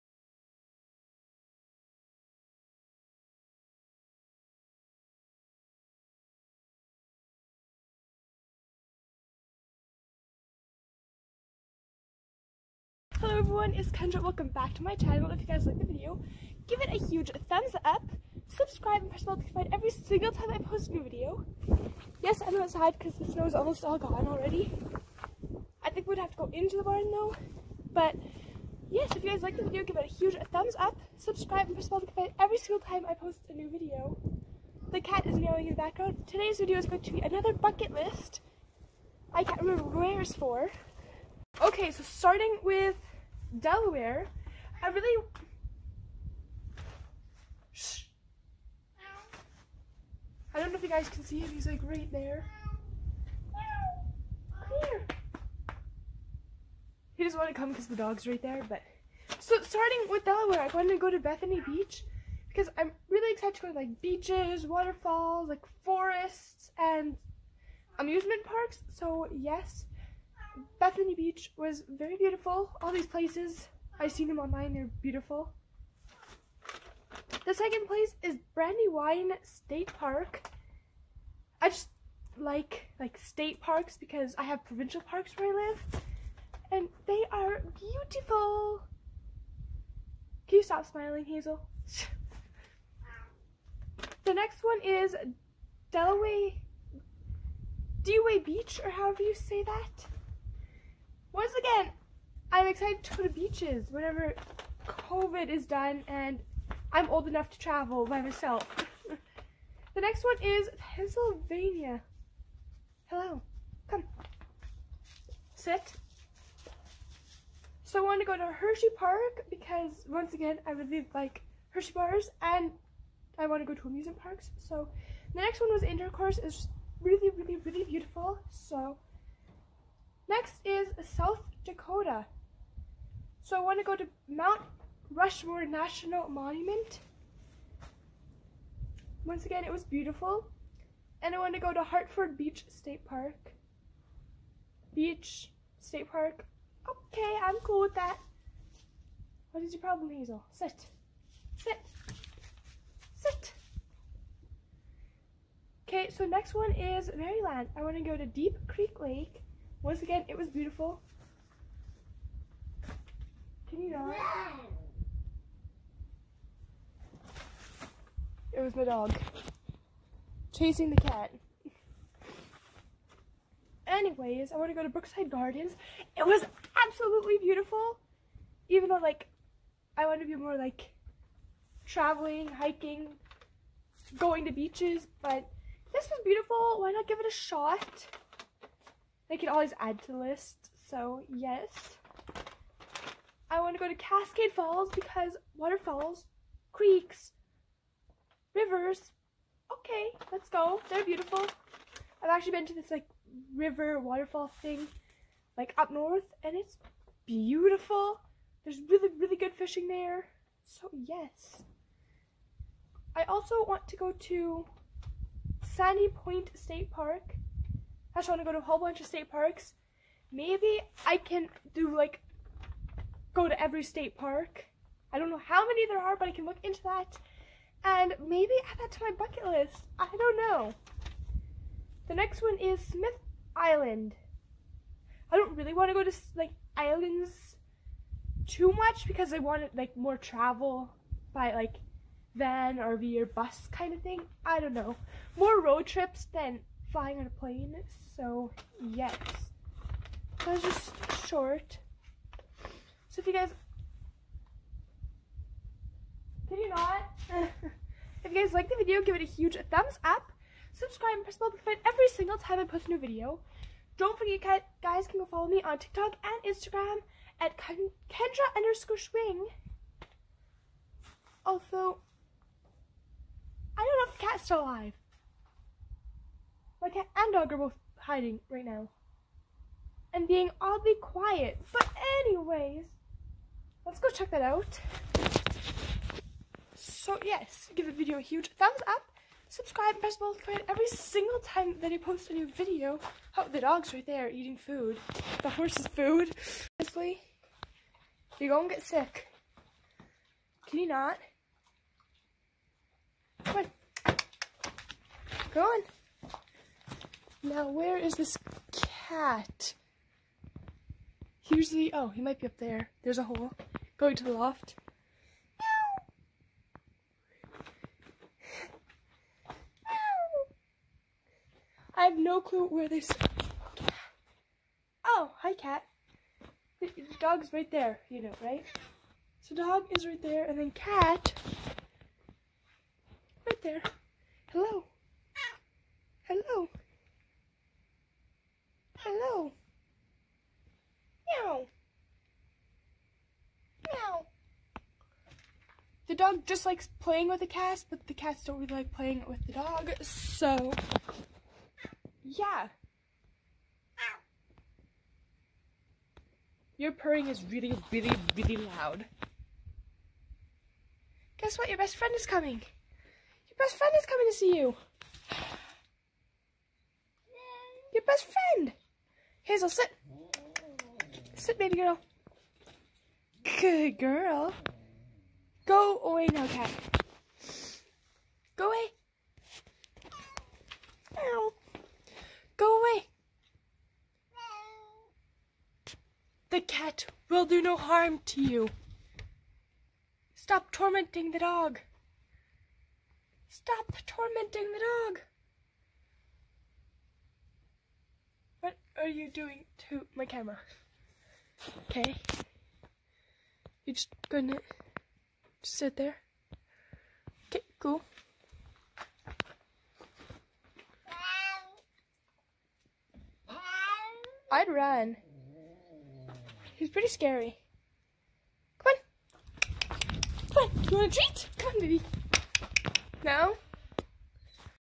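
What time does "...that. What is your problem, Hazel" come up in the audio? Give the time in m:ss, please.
2:27.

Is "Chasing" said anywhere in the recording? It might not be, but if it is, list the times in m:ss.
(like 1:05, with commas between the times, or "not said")
2:50.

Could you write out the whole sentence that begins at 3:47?
And maybe add that to my bucket list.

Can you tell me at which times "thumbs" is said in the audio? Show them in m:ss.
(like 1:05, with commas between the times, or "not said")
0:17, 0:30, 4:19, 4:48.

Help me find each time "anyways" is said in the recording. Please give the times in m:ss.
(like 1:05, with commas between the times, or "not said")
2:53, 4:42.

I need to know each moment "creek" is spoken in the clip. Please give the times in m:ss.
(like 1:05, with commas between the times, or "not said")
2:38, 3:16.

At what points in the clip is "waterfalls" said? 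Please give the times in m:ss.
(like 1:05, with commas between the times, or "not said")
1:04, 3:15, 3:24.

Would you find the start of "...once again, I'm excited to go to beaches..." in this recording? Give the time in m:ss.
1:41.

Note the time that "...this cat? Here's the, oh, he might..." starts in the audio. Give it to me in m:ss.
5:08.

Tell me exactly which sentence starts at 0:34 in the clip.
The cat is meowing in the background.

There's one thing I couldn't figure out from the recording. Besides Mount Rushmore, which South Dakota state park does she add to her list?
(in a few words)
Hartford Beach State Park.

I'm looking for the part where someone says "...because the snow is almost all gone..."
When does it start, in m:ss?
0:22.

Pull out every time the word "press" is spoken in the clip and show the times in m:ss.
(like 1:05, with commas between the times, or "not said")
0:19, 0:31, 4:21, 4:50.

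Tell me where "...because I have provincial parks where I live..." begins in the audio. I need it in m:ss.
1:23.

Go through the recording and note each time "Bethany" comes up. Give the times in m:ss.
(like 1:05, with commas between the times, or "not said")
1:01, 1:10.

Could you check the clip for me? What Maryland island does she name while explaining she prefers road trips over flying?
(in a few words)
Smith Island.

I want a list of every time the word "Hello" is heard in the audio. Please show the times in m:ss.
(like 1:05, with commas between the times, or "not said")
0:13, 1:53.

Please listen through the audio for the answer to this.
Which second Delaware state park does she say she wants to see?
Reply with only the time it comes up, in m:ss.
1:18.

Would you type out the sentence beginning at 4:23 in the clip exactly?
Don't forget, guys can go follow me on TikTok and Instagram at Kendra underscore Schwing.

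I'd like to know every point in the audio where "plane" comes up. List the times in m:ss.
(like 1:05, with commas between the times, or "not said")
4:07.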